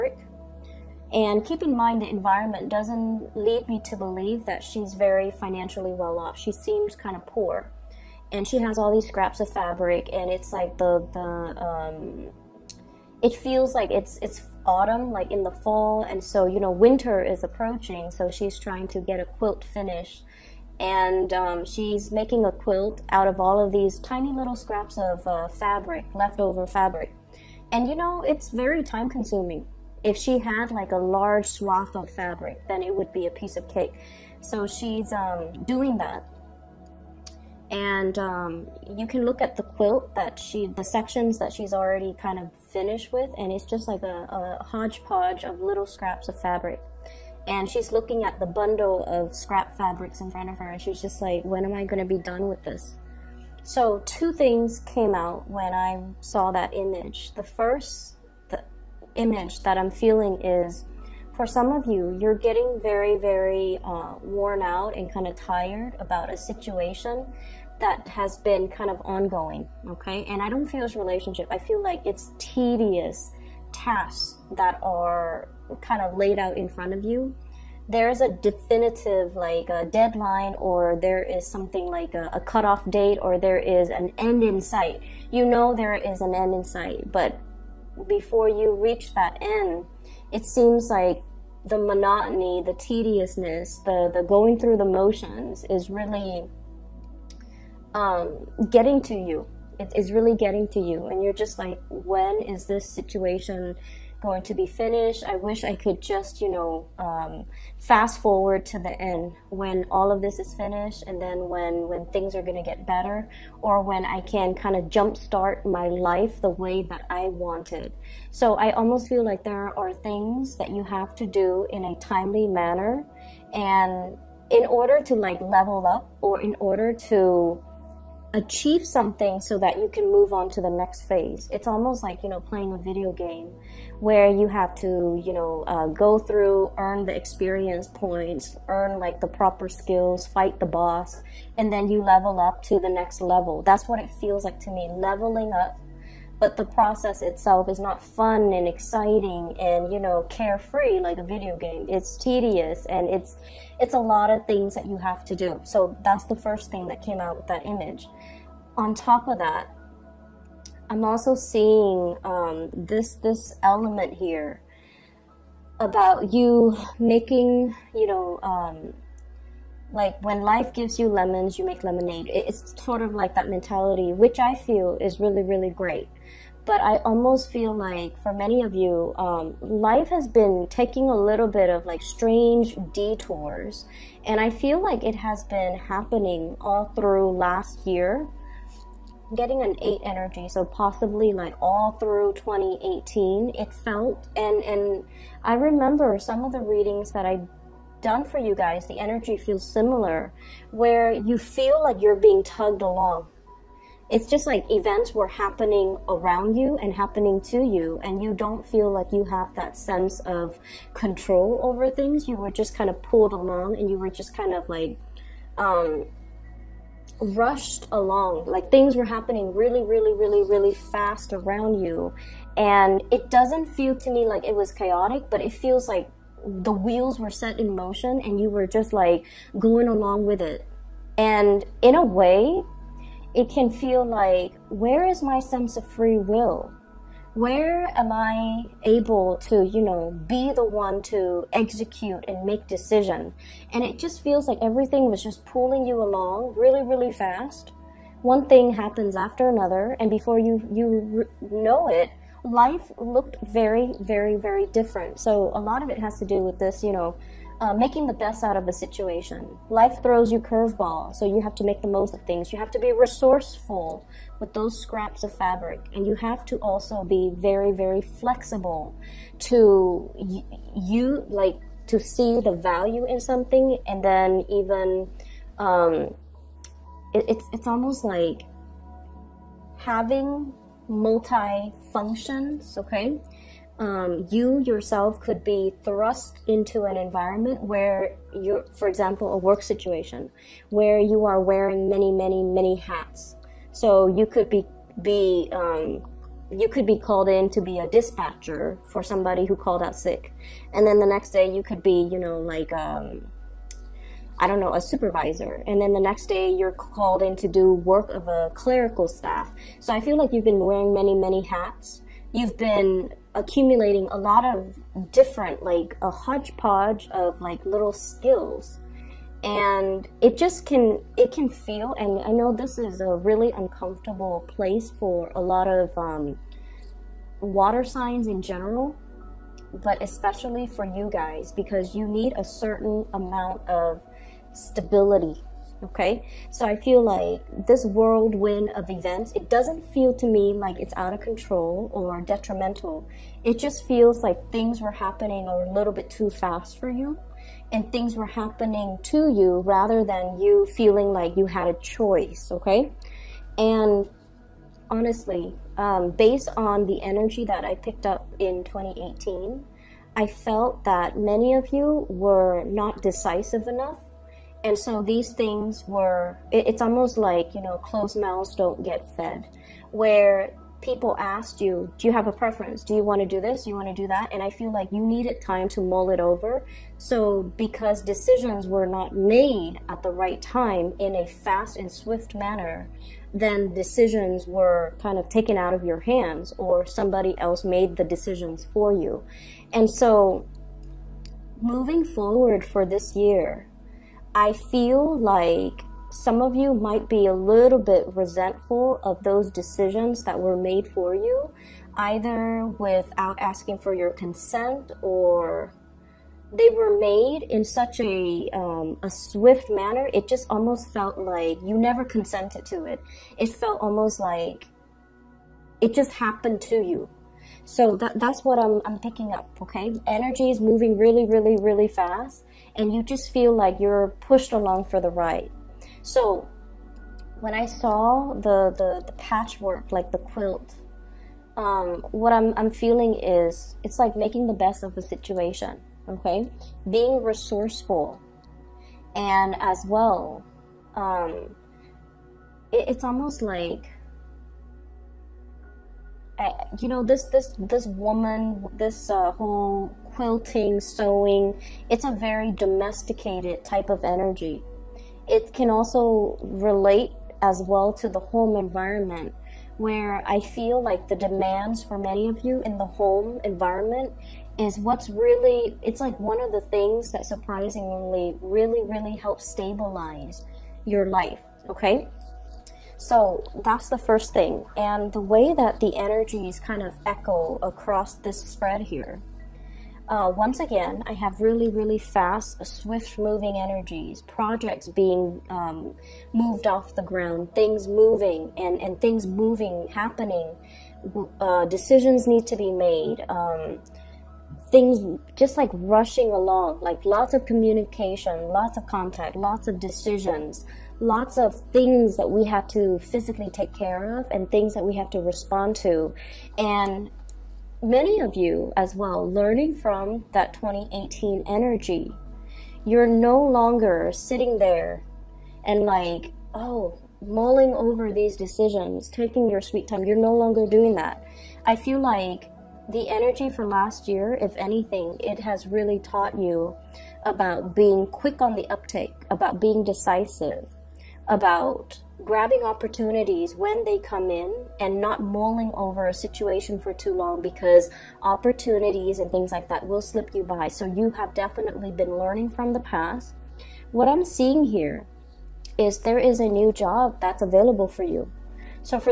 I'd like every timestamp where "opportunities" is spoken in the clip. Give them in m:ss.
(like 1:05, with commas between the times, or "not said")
8:52, 8:58.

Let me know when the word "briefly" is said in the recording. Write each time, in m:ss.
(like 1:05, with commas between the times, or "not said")
not said.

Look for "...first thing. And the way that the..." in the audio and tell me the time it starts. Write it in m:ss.
7:53.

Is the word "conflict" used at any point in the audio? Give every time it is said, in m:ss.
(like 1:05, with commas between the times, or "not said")
not said.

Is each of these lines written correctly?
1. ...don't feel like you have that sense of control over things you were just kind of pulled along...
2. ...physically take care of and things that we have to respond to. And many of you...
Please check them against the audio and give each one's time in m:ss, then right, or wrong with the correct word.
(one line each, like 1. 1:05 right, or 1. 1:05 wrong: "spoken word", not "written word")
1. 3:28 right
2. 8:22 right.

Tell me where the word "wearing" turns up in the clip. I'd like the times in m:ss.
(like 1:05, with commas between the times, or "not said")
4:51, 5:10.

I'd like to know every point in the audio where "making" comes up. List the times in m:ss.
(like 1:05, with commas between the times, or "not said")
0:22, 2:46, 4:17, 7:14.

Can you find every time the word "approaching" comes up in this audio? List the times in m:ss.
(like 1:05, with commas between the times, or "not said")
0:17.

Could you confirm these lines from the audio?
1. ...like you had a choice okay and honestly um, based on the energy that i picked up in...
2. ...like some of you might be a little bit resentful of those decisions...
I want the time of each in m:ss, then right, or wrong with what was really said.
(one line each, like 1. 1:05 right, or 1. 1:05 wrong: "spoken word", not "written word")
1. 5:51 right
2. 6:35 right.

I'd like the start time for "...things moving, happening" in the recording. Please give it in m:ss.
8:09.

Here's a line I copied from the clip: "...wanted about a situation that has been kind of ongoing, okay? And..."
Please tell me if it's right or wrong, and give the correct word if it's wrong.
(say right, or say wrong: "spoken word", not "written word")
wrong: "tired", not "wanted".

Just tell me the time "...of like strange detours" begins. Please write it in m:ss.
3:01.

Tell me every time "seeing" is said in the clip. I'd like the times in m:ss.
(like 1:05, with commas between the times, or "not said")
2:41, 9:04.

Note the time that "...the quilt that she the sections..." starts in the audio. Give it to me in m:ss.
0:39.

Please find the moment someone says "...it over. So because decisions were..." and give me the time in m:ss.
6:16.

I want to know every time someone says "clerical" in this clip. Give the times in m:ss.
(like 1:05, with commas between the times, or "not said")
5:08.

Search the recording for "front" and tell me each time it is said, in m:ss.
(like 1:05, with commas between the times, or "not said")
0:50, 1:16.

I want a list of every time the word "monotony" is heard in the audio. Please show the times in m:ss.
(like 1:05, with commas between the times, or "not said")
1:31.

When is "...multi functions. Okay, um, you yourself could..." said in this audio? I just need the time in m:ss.
4:40.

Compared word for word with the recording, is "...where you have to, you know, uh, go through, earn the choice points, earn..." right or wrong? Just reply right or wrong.
wrong.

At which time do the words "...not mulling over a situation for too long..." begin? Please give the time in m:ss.
8:55.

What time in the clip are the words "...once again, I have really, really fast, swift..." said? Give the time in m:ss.
8:00.